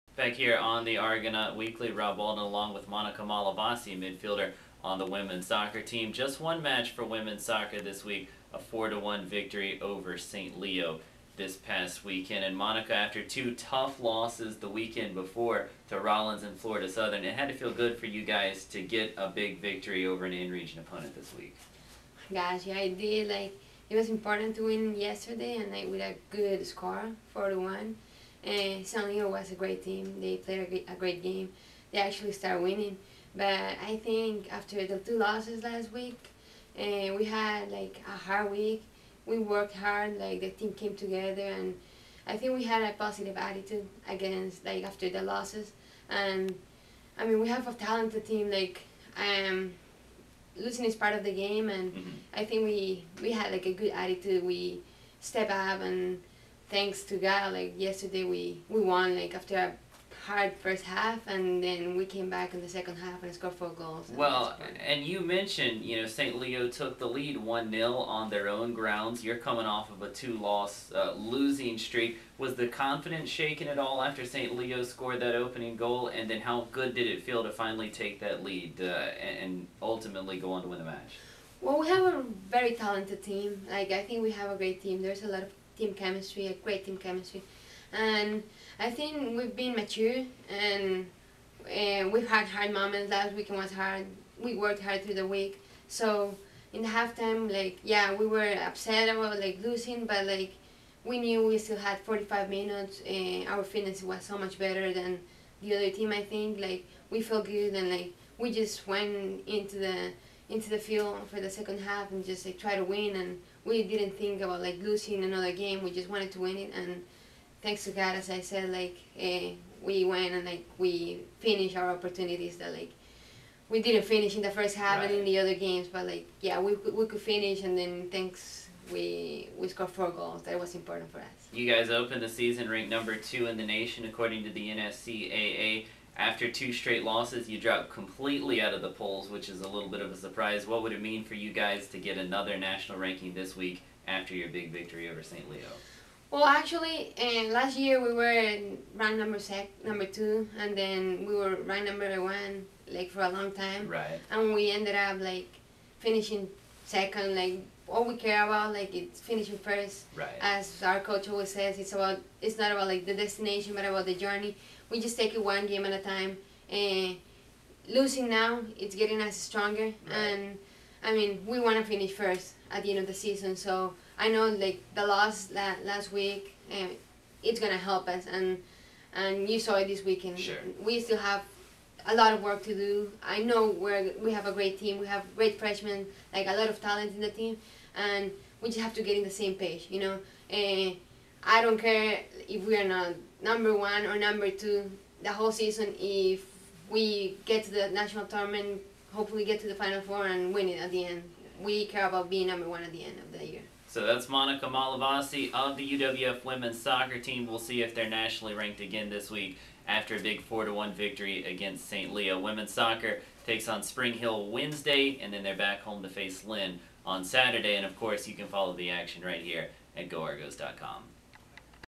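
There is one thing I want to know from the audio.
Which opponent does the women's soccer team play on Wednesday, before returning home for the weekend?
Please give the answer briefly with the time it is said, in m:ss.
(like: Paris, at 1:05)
Spring Hill, at 3:33.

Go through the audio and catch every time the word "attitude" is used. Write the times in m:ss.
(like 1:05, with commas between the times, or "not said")
0:43, 0:53.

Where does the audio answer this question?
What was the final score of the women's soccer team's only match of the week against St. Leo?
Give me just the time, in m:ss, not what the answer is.
0:08.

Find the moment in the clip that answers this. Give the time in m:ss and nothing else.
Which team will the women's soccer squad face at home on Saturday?
3:36.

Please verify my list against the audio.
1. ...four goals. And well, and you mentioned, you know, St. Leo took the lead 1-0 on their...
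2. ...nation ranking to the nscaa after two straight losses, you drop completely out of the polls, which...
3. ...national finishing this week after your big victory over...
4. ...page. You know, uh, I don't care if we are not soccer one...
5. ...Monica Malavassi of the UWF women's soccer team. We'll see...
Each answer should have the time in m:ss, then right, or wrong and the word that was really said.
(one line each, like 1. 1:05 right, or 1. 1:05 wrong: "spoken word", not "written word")
1. 1:03 right
2. 2:13 wrong: "according", not "ranking"
3. 2:22 wrong: "ranking", not "finishing"
4. 3:09 wrong: "number", not "soccer"
5. 3:24 right.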